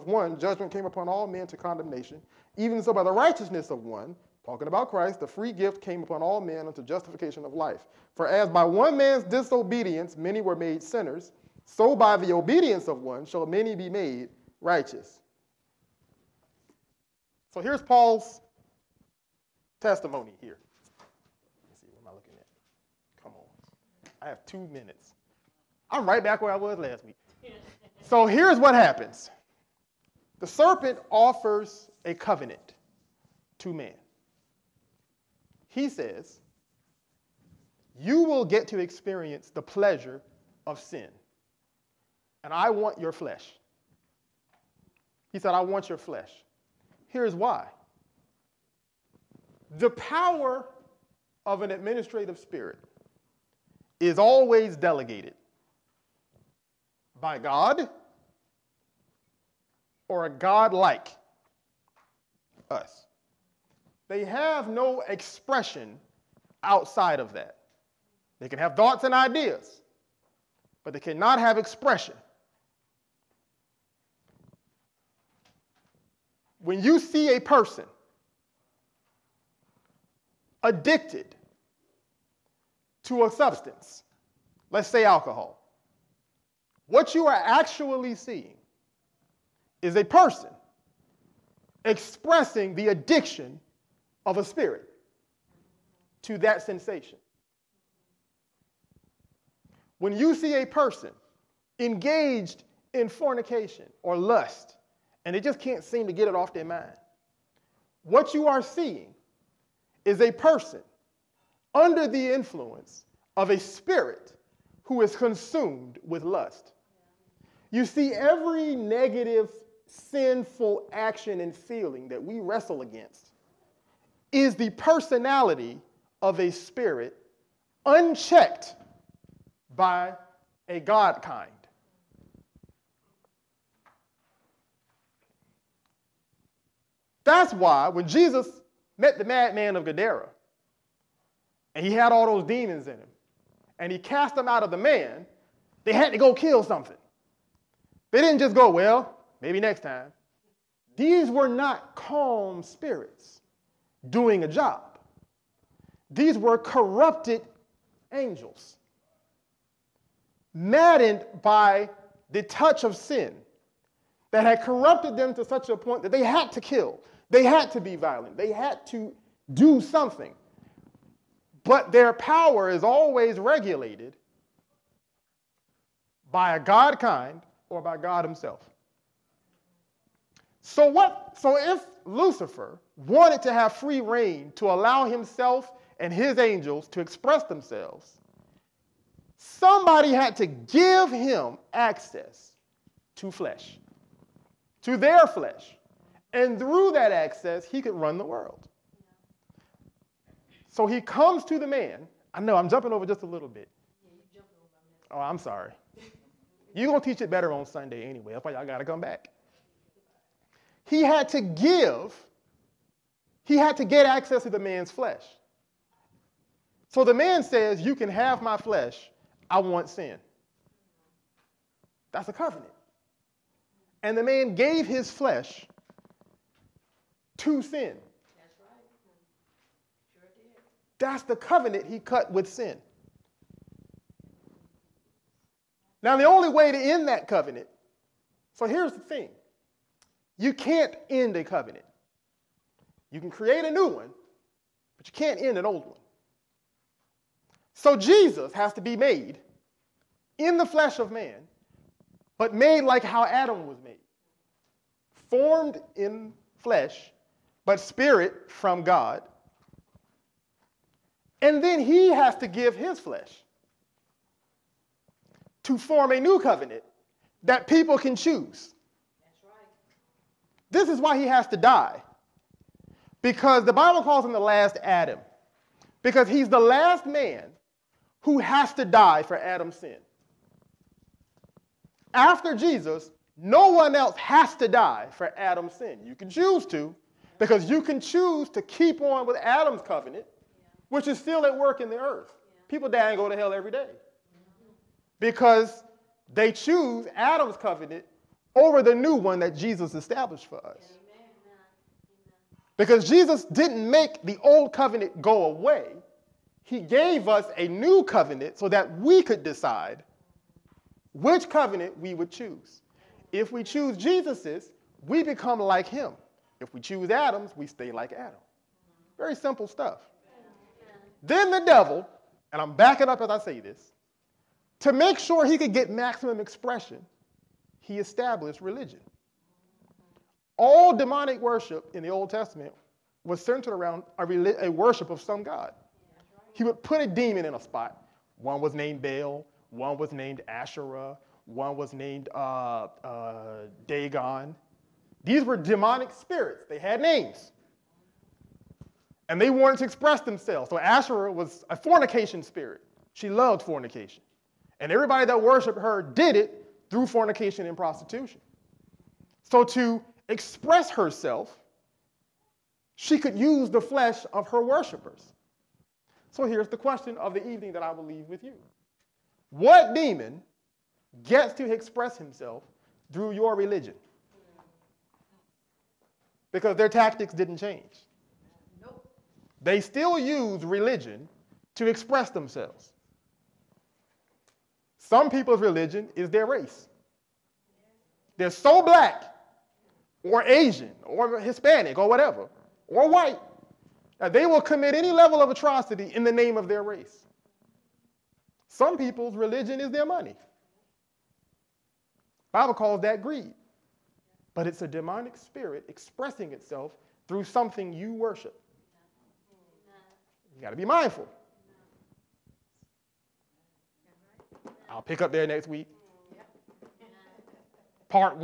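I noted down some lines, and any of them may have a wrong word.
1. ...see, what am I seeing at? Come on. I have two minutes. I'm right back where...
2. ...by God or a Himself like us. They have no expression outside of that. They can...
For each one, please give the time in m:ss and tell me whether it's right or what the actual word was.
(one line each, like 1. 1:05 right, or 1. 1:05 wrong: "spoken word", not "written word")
1. 0:21 wrong: "looking", not "seeing"
2. 0:57 wrong: "God", not "Himself".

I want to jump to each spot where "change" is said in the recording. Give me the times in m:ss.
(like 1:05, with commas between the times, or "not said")
6:17.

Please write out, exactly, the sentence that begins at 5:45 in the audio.
These were demonic spirits, they had names.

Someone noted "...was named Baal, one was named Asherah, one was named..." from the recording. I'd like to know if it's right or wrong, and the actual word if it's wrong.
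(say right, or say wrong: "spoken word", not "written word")
right.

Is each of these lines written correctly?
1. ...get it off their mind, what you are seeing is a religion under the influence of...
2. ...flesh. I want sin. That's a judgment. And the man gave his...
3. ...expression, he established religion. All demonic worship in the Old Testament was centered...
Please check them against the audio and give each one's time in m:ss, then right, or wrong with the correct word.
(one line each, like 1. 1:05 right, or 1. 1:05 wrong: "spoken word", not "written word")
1. 1:46 wrong: "person", not "religion"
2. 3:38 wrong: "covenant", not "judgment"
3. 5:26 right.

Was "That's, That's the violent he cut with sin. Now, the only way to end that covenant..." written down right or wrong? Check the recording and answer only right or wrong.
wrong.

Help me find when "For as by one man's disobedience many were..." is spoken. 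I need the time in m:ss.
0:08.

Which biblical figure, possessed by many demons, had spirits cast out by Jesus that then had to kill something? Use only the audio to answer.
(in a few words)
madman of Gadara.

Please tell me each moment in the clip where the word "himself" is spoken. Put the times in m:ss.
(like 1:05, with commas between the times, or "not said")
2:58, 3:05, 6:12.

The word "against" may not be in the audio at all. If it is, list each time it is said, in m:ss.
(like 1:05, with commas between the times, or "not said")
2:02.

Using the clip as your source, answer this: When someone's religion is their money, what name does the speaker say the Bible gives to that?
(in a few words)
greed.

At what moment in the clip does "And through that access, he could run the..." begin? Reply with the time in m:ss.
3:16.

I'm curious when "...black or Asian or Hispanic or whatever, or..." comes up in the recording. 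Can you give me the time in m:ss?
6:28.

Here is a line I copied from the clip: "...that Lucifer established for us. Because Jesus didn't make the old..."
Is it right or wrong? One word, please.
wrong.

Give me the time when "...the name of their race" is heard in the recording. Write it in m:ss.
6:36.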